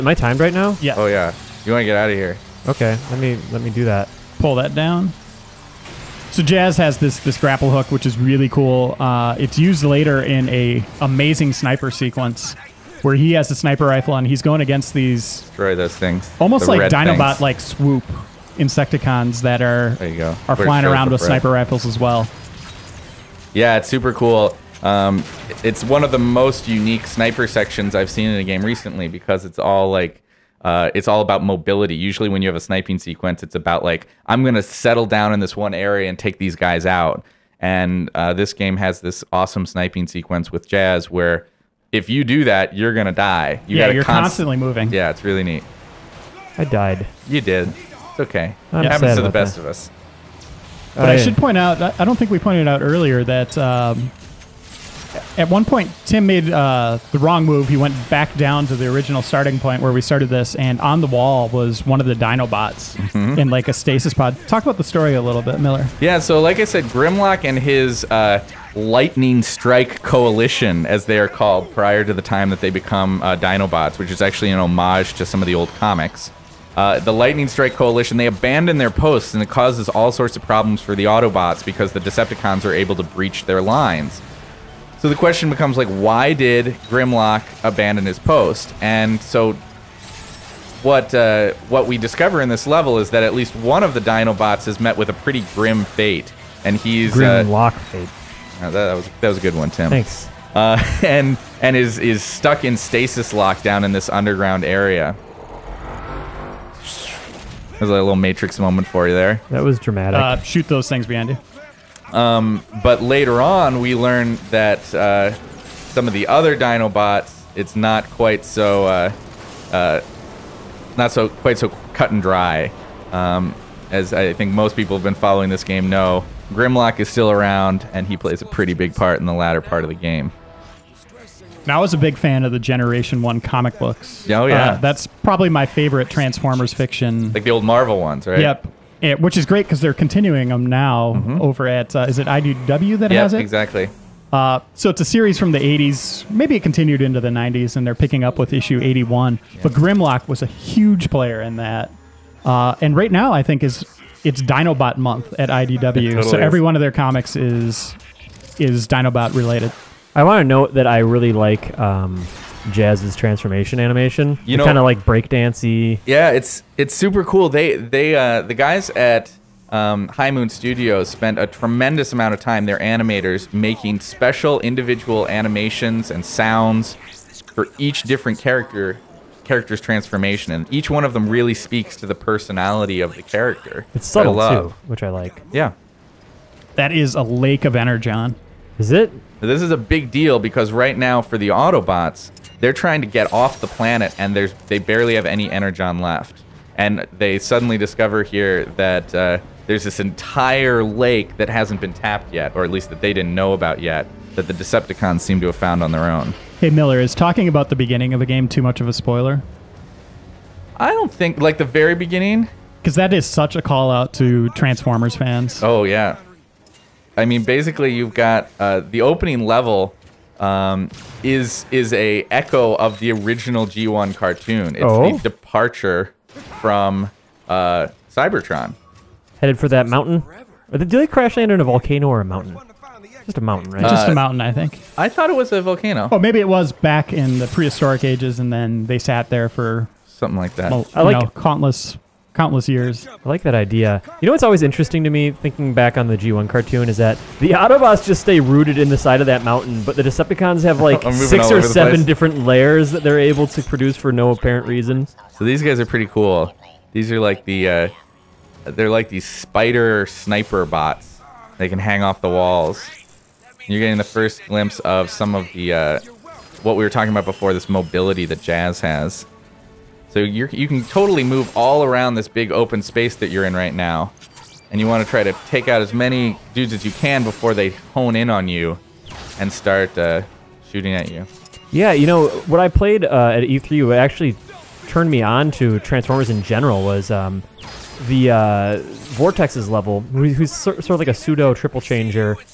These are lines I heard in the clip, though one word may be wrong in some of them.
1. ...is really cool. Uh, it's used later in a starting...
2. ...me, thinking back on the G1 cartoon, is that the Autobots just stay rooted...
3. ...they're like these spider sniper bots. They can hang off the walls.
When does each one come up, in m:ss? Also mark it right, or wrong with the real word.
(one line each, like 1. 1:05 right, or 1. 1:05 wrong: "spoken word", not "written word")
1. 0:08 wrong: "amazing", not "starting"
2. 4:05 right
3. 4:18 right.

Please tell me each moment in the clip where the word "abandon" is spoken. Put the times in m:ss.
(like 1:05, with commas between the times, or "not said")
1:18, 1:27.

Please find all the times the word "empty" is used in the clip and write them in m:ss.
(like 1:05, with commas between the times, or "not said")
not said.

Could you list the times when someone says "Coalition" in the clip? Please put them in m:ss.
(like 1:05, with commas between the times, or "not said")
1:10, 1:17.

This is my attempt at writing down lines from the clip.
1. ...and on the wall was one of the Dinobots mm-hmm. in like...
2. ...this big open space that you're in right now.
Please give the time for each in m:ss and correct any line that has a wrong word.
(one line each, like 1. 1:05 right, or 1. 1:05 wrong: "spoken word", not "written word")
1. 1:00 right
2. 4:32 right.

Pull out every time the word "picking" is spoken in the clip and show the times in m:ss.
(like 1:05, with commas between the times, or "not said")
2:27.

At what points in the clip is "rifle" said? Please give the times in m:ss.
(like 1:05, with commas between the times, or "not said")
0:13, 0:21.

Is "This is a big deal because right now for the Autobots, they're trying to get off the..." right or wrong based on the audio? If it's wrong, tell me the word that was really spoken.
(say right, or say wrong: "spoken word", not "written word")
right.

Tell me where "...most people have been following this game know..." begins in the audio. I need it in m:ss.
2:04.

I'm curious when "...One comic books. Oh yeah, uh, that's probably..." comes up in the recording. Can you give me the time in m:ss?
2:13.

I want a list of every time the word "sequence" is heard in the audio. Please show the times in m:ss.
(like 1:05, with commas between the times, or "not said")
0:11, 0:32, 0:40.